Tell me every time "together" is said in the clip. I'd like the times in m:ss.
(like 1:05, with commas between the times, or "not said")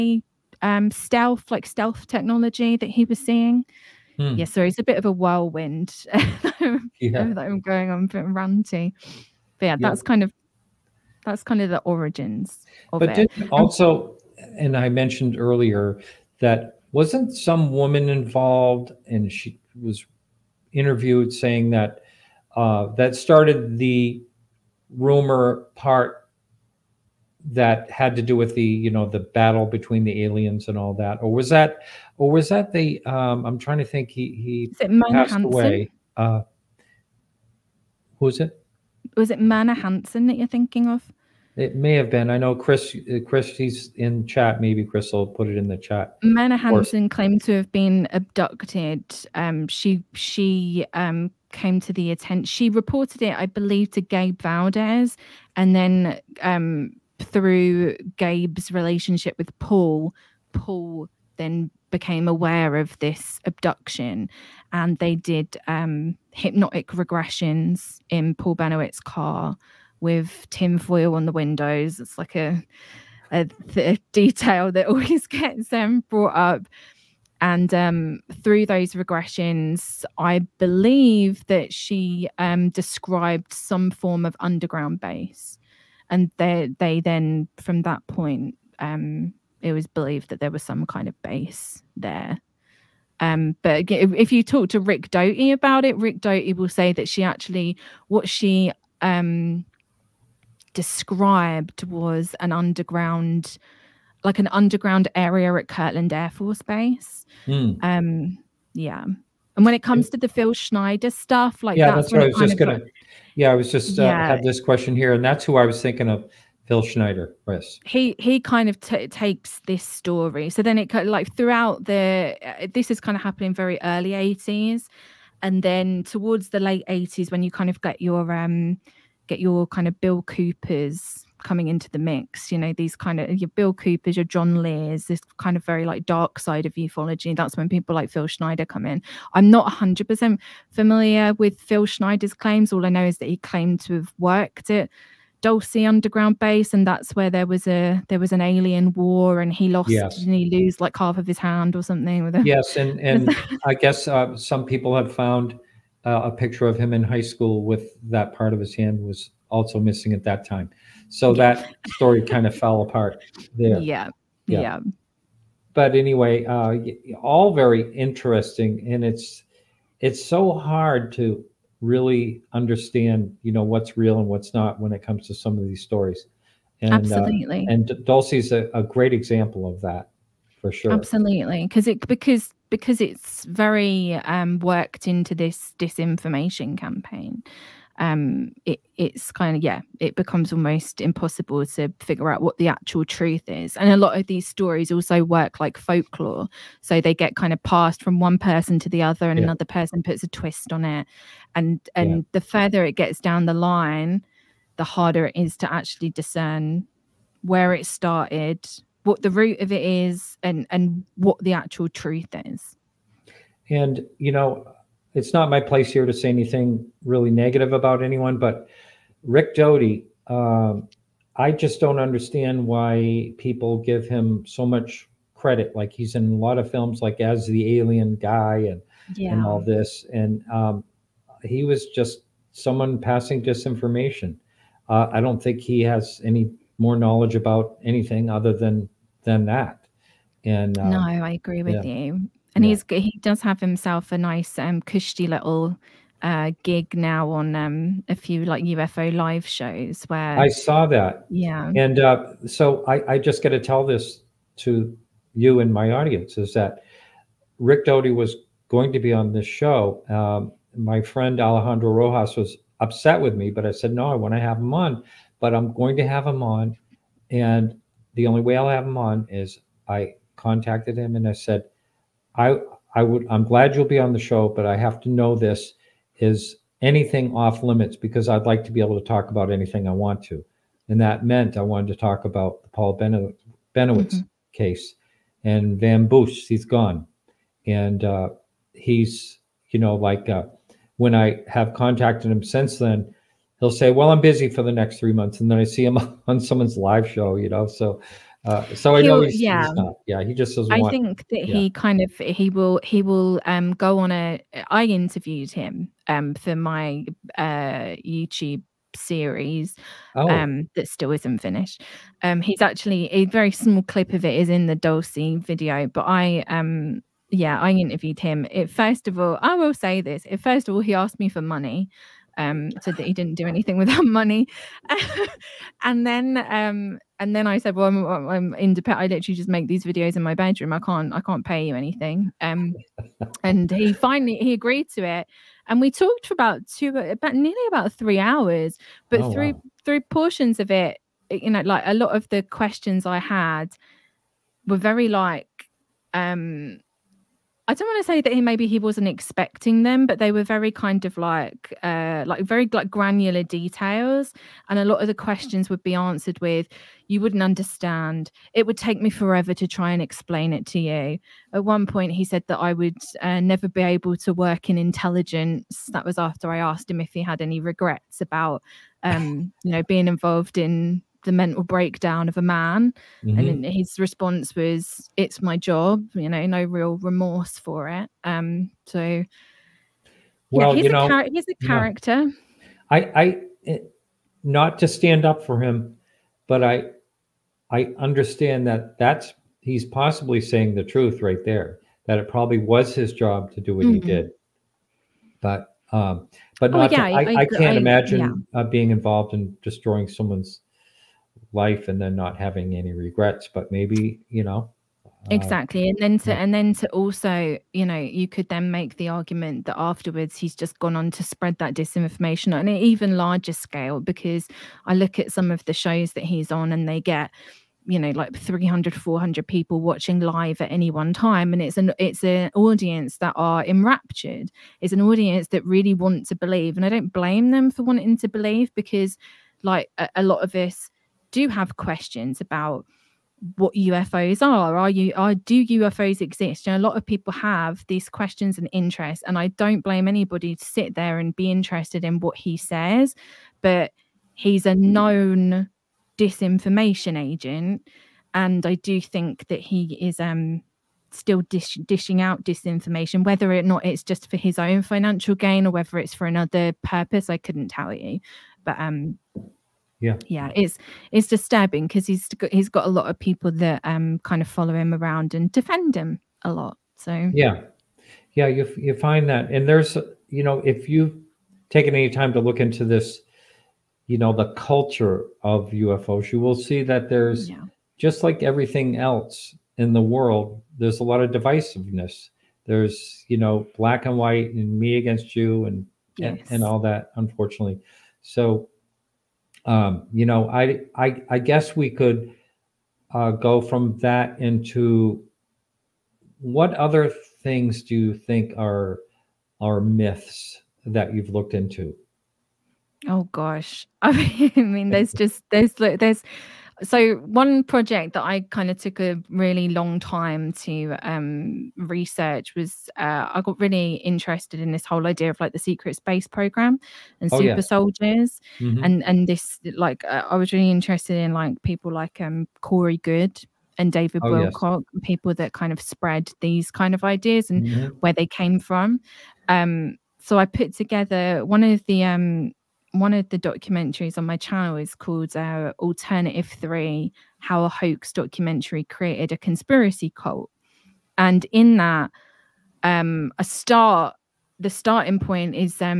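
8:50.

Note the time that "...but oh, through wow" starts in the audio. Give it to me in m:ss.
5:39.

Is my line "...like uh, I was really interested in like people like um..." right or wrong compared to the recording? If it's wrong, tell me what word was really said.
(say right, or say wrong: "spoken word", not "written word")
right.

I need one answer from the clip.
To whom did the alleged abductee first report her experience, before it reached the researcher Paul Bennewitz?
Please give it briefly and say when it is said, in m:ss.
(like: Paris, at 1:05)
Gabe Valdez, at 0:54.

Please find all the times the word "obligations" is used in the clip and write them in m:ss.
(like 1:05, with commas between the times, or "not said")
not said.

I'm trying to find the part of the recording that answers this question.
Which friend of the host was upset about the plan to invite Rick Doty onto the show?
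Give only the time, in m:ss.
4:21.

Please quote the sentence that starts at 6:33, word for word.
he did but um but oh, not oh, yeah, to, I, I, I, can't I, imagine yeah.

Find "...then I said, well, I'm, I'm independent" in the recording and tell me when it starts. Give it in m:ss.
5:27.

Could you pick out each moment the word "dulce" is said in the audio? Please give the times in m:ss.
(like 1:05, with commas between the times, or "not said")
2:25, 2:58, 5:14.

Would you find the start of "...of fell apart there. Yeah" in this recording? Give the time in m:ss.
2:42.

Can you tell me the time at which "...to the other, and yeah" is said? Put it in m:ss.
3:18.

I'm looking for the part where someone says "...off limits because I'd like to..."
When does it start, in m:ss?
4:37.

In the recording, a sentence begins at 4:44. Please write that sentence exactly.
case and Van Bush, he's gone.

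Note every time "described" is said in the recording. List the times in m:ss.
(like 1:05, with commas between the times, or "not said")
1:22, 1:40.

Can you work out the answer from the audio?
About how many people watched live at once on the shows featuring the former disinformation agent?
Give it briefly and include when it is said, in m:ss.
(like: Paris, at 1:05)
300 to 400, at 6:58.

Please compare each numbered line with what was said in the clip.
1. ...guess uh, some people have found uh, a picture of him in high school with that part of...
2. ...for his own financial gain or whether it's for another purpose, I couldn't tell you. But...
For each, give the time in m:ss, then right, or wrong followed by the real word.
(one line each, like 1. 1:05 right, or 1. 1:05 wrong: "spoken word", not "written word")
1. 2:33 right
2. 7:34 right.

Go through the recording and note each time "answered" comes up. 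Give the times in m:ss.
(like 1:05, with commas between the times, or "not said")
5:55.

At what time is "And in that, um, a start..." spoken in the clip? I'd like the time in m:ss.
9:01.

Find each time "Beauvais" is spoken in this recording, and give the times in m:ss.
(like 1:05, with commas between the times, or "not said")
not said.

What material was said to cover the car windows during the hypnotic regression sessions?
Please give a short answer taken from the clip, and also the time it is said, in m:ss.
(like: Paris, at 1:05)
tinfoil, at 1:10.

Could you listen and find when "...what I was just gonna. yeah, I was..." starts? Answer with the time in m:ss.
1:52.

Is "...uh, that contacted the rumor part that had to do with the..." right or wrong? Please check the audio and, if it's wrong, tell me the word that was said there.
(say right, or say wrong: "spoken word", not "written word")
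wrong: "started", not "contacted".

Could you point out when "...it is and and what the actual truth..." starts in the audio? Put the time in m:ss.
3:29.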